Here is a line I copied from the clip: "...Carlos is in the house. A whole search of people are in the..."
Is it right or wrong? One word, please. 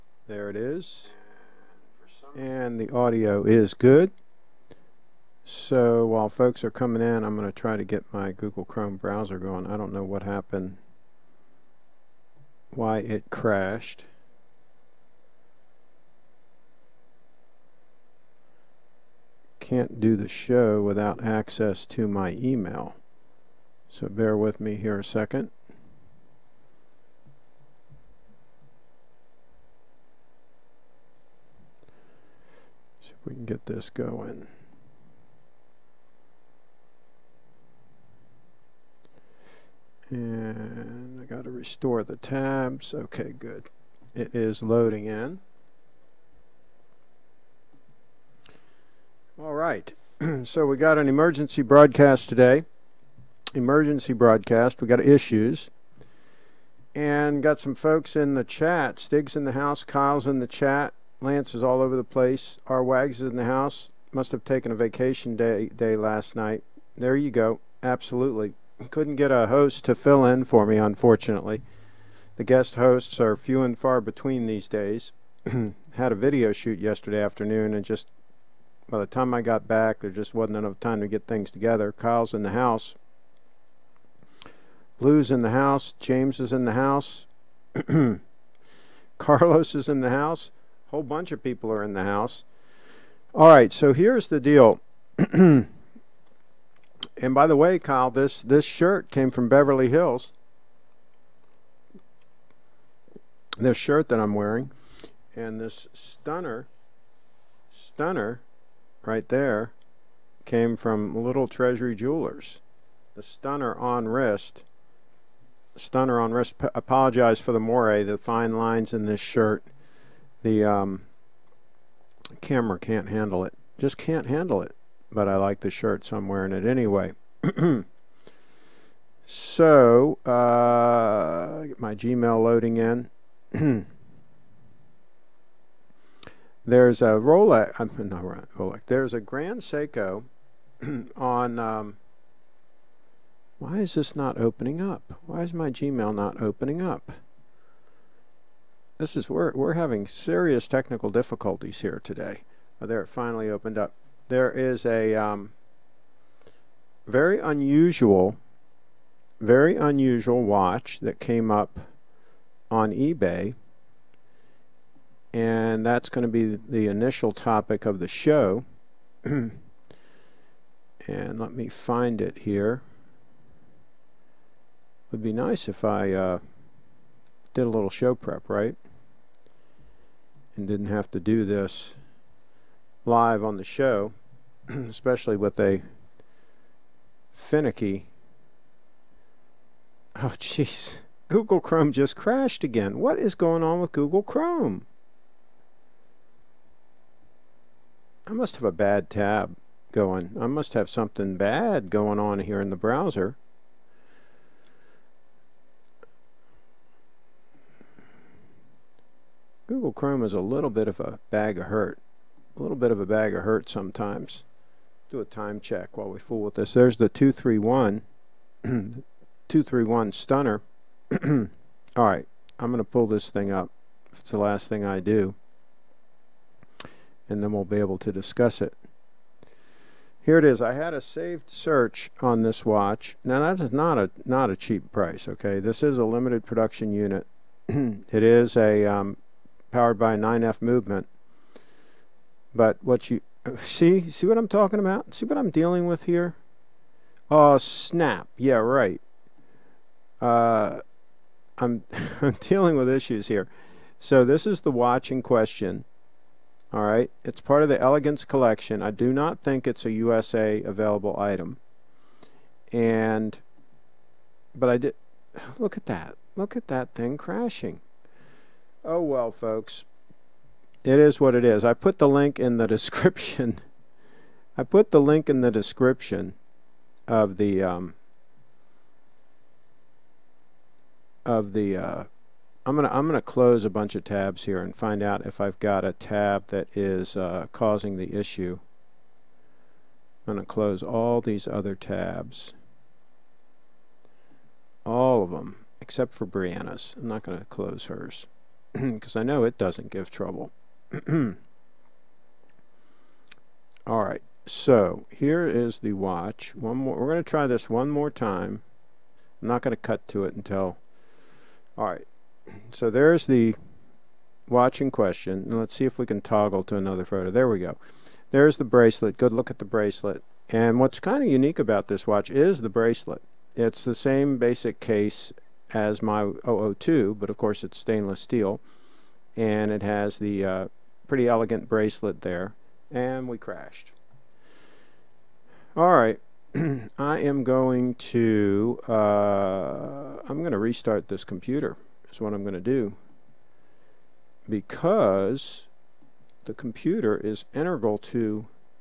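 wrong.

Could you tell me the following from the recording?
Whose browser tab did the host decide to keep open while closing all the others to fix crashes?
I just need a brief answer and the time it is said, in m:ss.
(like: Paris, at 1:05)
Brianna, at 4:56.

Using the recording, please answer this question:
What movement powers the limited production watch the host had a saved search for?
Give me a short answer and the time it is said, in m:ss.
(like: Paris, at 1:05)
9F, at 4:00.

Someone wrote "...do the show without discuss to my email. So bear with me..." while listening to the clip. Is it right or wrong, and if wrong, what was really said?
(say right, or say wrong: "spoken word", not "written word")
wrong: "access", not "discuss".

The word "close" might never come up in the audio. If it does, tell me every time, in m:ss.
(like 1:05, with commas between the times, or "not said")
4:43, 4:50, 4:57.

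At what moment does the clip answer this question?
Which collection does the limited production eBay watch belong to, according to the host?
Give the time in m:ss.
4:17.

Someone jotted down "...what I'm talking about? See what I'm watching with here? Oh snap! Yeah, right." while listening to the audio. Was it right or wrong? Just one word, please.
wrong.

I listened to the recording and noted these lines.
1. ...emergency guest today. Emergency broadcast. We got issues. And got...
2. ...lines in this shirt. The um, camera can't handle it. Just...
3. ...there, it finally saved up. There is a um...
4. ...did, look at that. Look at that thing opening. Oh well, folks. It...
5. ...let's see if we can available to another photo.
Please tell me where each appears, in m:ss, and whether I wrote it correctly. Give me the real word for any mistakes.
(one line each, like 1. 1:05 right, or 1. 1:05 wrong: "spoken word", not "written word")
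1. 0:51 wrong: "broadcast", not "guest"
2. 1:58 right
3. 2:32 wrong: "opened", not "saved"
4. 4:24 wrong: "crashing", not "opening"
5. 5:15 wrong: "toggle", not "available".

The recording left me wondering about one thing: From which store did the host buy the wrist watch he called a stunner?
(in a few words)
Little Treasury Jewelers.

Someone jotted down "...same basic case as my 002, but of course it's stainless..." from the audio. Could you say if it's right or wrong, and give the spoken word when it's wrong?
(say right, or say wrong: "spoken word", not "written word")
right.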